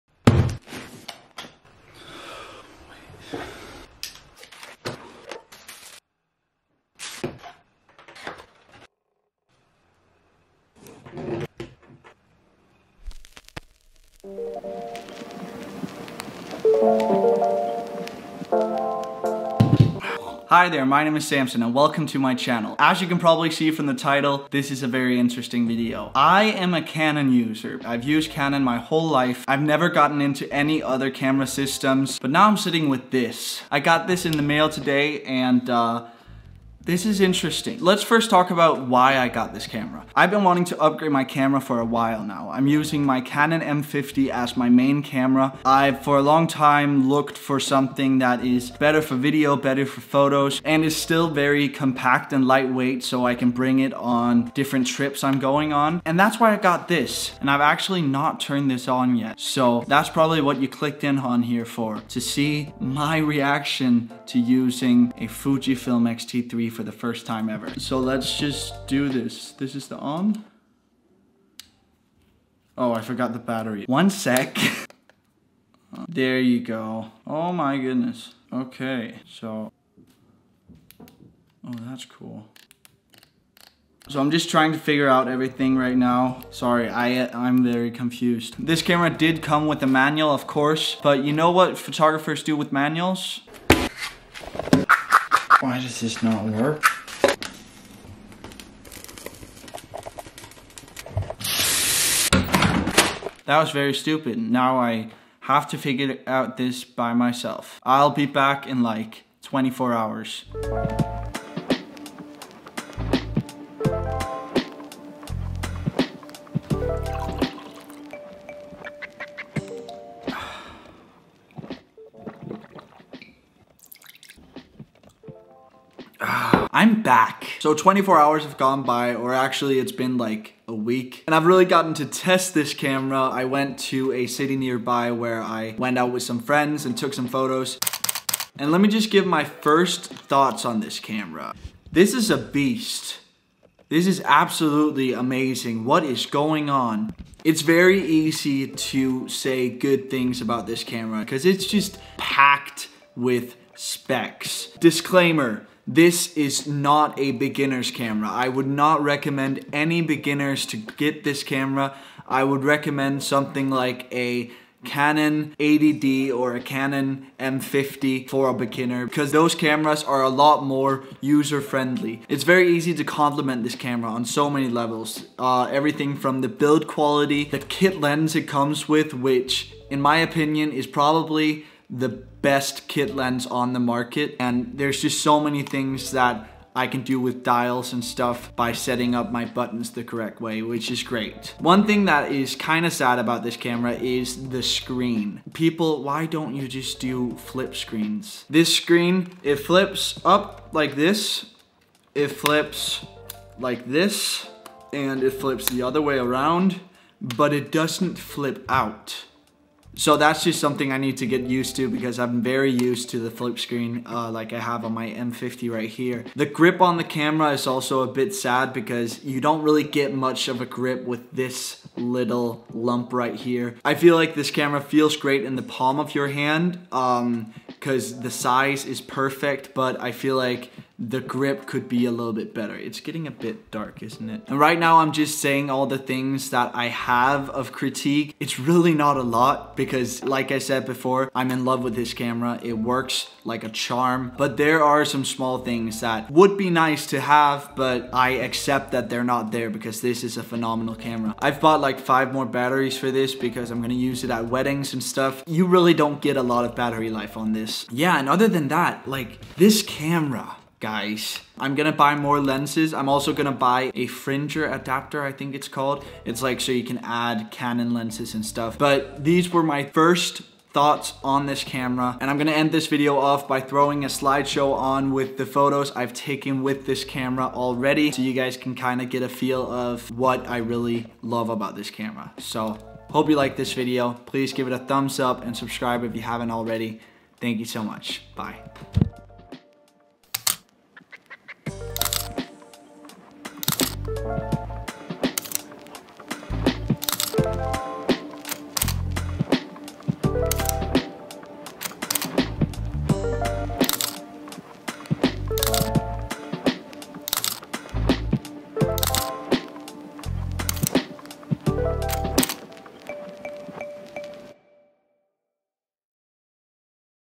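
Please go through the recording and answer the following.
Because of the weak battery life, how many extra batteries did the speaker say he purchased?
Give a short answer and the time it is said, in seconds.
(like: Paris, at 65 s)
5, at 251 s.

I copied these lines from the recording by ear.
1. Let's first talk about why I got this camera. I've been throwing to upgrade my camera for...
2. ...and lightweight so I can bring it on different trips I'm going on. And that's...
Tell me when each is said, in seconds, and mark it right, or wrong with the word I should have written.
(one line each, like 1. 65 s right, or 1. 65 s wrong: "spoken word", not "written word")
1. 37 s wrong: "wanting", not "throwing"
2. 52 s right.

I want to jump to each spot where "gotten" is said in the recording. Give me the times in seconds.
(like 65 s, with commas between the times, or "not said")
29 s, 131 s.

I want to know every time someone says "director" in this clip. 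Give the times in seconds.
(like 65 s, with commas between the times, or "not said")
not said.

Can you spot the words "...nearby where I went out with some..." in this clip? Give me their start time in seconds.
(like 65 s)
134 s.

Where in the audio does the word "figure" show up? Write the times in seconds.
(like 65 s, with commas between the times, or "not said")
84 s, 105 s.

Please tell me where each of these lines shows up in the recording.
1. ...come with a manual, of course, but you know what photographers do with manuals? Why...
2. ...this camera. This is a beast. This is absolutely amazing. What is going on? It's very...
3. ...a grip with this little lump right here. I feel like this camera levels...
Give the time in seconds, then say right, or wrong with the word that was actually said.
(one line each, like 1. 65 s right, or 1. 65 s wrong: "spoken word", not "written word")
1. 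89 s right
2. 140 s right
3. 220 s wrong: "feels", not "levels".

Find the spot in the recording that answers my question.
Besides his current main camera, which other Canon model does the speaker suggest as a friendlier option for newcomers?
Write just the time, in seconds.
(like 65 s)
164 s.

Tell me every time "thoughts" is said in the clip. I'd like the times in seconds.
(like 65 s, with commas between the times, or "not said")
140 s, 270 s.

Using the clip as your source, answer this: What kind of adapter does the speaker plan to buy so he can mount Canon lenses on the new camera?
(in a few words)
Fringer adapter.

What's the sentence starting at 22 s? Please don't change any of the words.
As you can probably see from the title, this is a very interesting video.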